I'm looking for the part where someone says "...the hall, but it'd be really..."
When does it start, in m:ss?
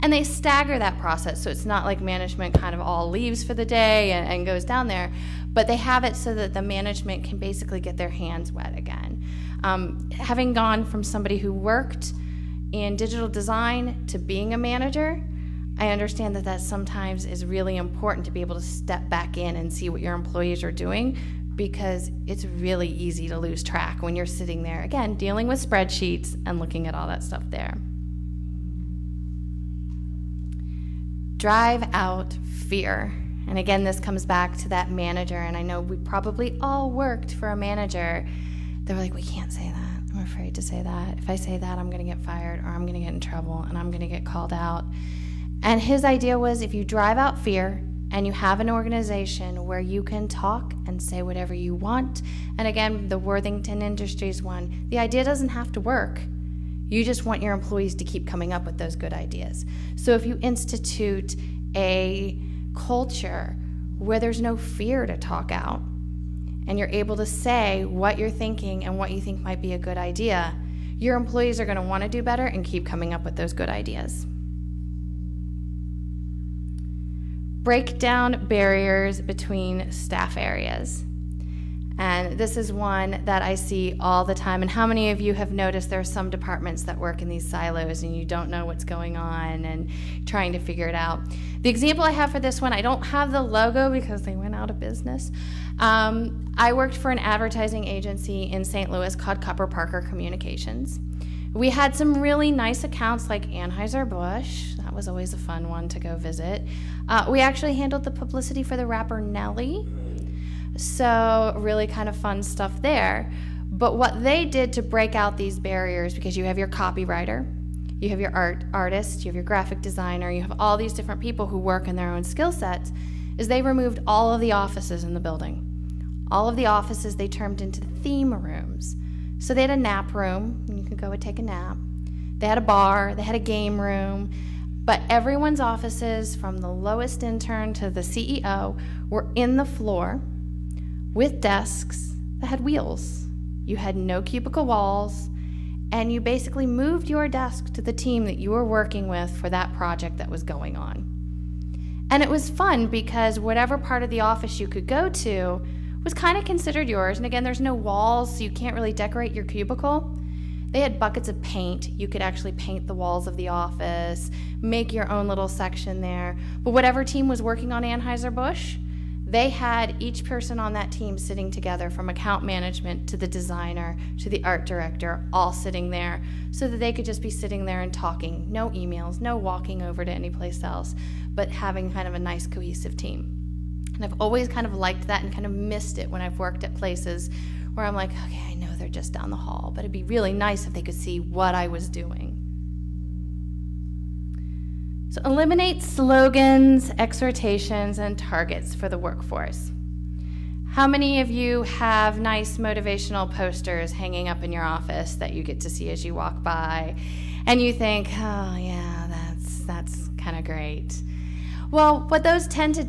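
3:09.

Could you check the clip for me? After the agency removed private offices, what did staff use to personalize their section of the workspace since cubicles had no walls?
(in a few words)
buckets of paint.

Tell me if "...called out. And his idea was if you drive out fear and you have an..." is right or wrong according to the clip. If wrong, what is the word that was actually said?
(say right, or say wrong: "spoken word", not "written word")
right.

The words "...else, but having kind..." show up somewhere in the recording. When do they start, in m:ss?
3:00.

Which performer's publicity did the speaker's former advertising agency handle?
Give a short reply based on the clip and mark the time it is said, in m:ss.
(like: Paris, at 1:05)
Nelly, at 1:49.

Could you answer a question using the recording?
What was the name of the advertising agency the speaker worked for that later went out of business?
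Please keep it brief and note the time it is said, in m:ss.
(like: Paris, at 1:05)
Kupper Parker Communications, at 1:39.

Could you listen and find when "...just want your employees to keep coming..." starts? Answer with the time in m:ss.
0:57.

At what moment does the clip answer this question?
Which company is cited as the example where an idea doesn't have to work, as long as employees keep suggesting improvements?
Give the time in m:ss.
0:53.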